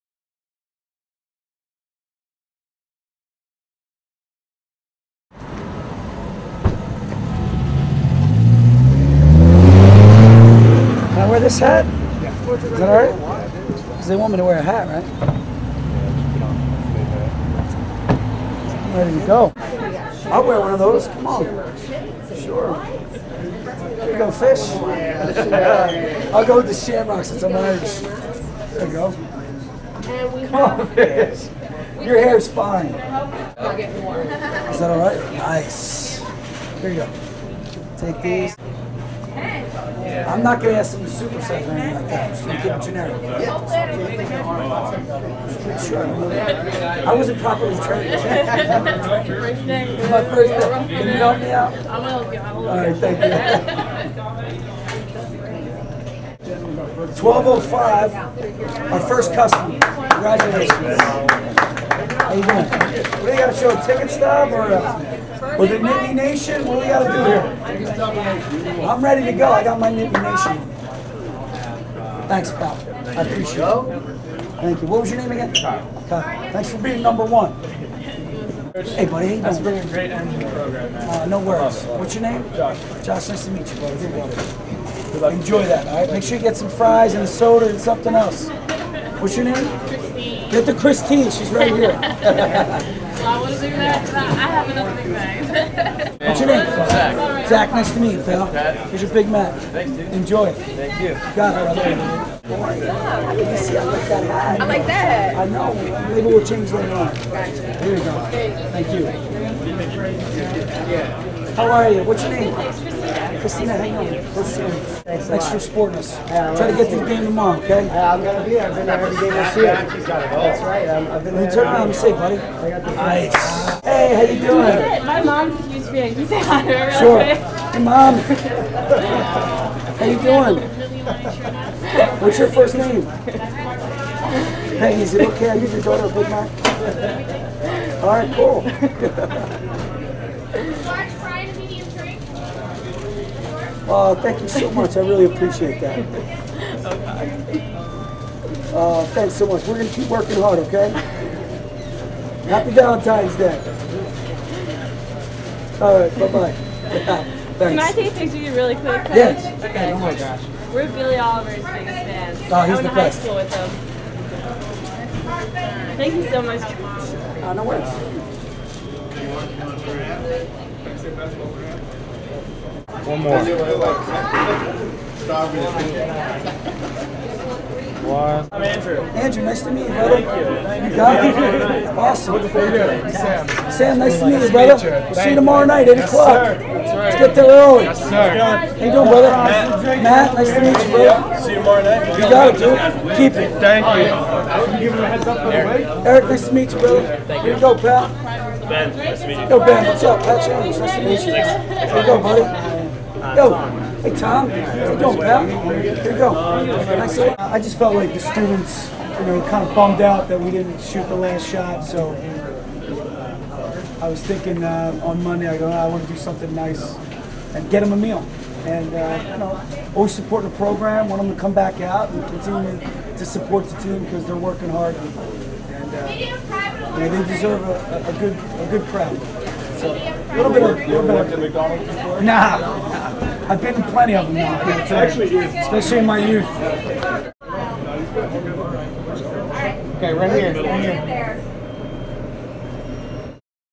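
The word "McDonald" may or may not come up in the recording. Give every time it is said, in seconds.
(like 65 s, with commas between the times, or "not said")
231 s.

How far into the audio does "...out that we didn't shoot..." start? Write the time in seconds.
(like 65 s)
209 s.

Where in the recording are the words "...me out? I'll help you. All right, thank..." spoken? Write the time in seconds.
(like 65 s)
51 s.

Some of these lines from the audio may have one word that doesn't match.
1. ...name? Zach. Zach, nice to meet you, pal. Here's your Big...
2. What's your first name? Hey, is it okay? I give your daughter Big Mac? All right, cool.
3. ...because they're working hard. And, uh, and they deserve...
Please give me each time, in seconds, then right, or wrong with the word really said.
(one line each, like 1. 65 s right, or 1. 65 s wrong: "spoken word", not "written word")
1. 96 s right
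2. 132 s right
3. 224 s right.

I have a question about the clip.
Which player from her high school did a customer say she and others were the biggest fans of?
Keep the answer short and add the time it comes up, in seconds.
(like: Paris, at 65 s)
Billy Oliver, at 160 s.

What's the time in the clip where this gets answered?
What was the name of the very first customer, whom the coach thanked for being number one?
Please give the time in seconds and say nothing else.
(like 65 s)
75 s.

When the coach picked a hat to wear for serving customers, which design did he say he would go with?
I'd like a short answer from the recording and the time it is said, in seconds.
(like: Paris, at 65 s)
Shamrocks, at 26 s.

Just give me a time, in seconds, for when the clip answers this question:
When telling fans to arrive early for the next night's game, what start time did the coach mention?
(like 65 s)
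185 s.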